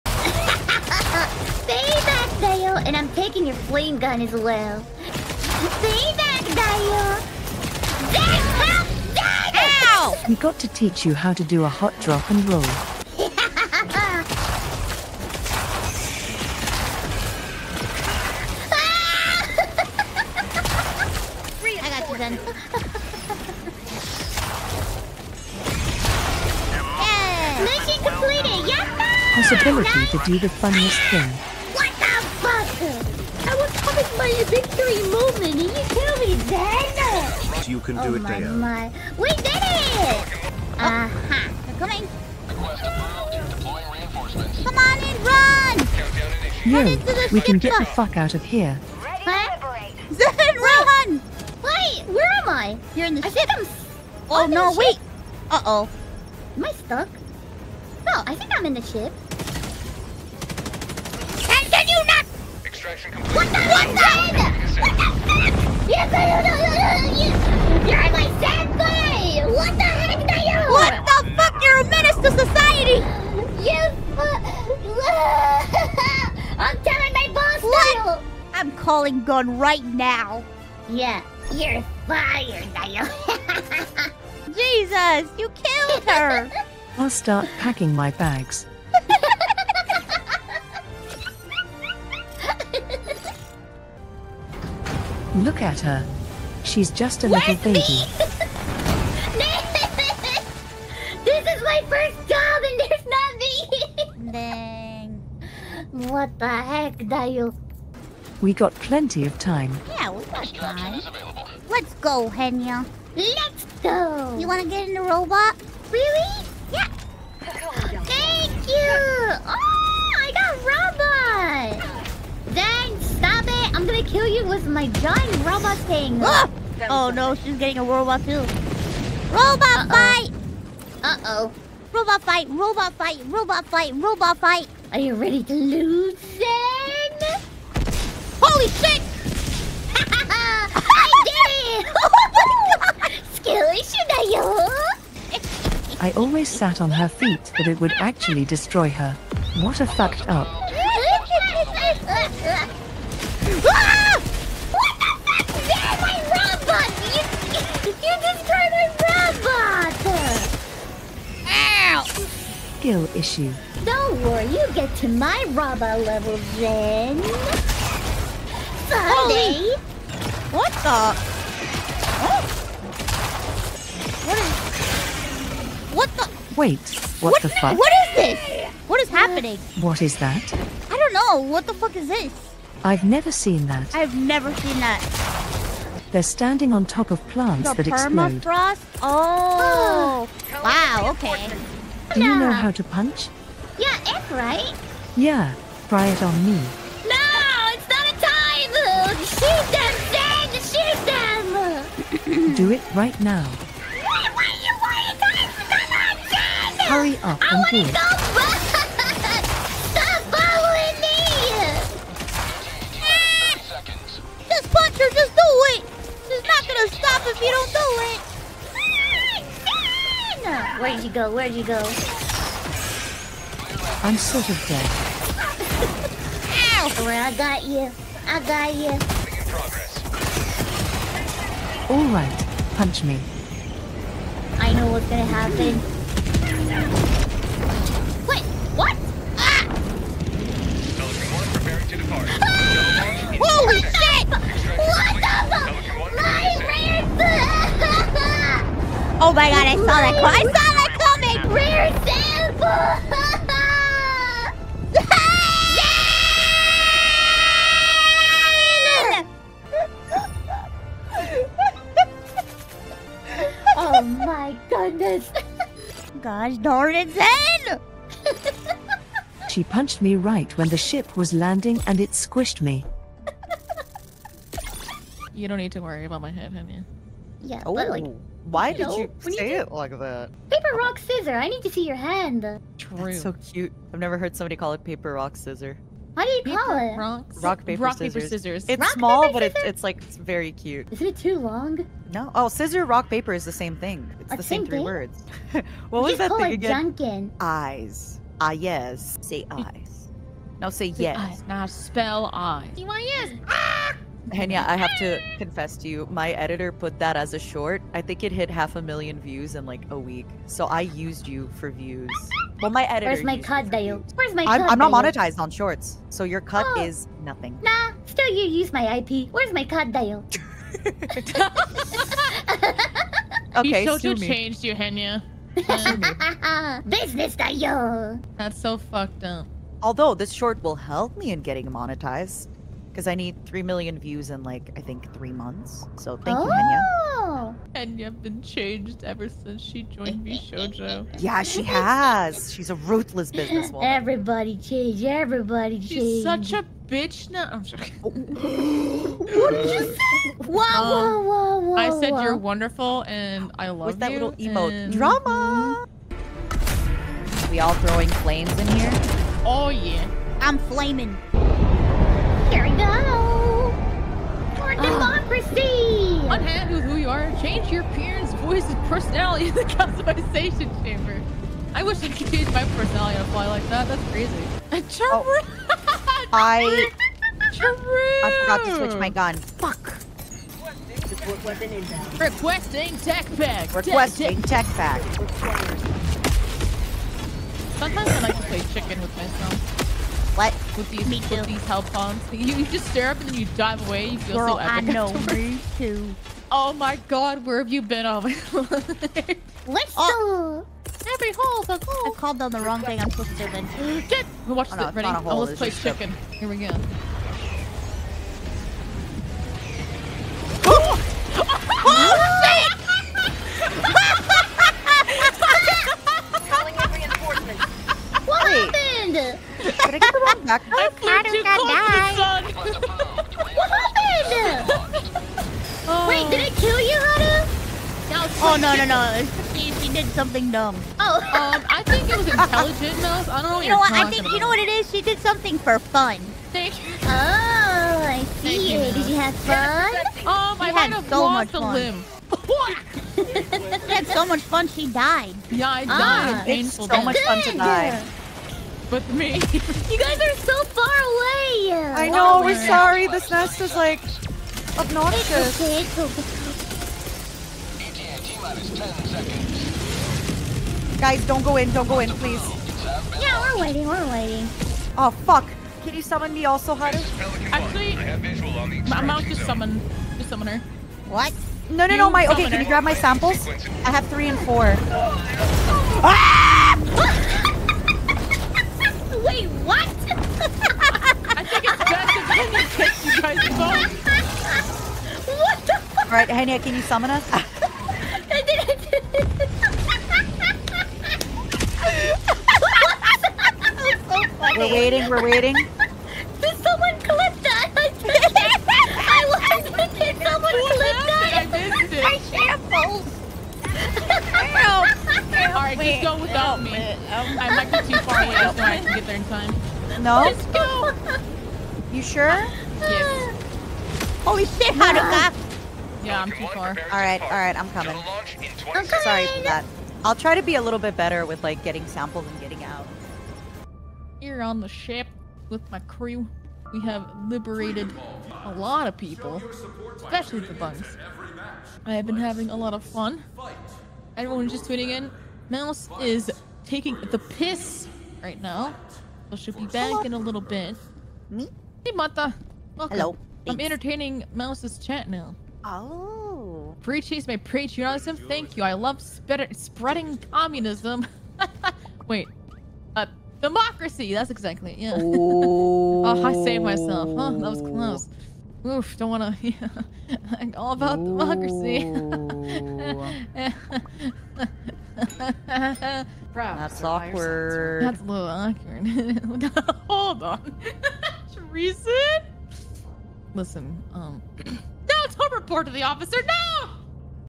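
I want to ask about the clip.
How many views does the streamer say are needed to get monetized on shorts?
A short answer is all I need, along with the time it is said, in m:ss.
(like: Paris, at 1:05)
3 million, at 5:33.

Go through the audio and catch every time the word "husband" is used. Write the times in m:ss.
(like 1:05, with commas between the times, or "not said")
not said.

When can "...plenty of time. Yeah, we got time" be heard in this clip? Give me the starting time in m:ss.
1:48.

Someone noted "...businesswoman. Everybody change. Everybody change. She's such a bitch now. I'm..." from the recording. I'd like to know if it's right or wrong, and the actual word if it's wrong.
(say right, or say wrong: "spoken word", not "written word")
right.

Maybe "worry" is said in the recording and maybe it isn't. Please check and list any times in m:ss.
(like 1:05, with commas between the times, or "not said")
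2:44, 4:35.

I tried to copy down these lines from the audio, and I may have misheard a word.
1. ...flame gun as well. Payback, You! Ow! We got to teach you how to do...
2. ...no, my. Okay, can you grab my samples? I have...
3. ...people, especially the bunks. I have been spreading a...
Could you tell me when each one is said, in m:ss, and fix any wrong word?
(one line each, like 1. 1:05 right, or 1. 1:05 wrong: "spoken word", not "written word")
1. 0:03 wrong: "Dayo", not "You"
2. 7:51 right
3. 8:48 wrong: "having", not "spreading".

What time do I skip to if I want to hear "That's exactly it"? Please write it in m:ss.
9:14.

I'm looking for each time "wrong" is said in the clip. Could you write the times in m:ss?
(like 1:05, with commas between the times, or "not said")
6:42.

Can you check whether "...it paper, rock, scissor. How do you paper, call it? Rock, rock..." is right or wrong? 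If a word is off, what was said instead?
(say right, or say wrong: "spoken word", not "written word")
right.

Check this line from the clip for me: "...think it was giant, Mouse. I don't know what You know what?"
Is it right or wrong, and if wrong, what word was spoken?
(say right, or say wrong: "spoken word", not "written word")
wrong: "intelligent", not "giant".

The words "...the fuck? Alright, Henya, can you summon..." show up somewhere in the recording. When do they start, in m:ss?
8:05.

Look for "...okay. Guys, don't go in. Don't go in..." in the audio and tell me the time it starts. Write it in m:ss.
7:35.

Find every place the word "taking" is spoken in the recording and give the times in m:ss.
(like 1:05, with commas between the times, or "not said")
0:03, 8:56.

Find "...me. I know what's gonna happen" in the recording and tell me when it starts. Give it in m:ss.
3:53.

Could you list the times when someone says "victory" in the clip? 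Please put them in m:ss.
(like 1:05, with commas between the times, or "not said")
0:34.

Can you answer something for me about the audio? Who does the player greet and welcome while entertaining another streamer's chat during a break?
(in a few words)
Mata.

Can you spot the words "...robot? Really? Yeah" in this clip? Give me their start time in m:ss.
1:55.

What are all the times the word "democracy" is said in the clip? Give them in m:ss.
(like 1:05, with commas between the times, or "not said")
6:04, 9:13, 9:21.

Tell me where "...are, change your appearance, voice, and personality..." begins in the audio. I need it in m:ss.
6:07.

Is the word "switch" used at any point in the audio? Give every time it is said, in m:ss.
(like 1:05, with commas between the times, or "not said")
6:18.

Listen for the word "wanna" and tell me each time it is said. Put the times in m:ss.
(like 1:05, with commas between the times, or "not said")
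1:54, 9:19.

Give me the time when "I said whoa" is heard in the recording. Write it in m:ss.
5:51.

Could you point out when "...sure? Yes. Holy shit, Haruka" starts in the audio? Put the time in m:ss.
8:32.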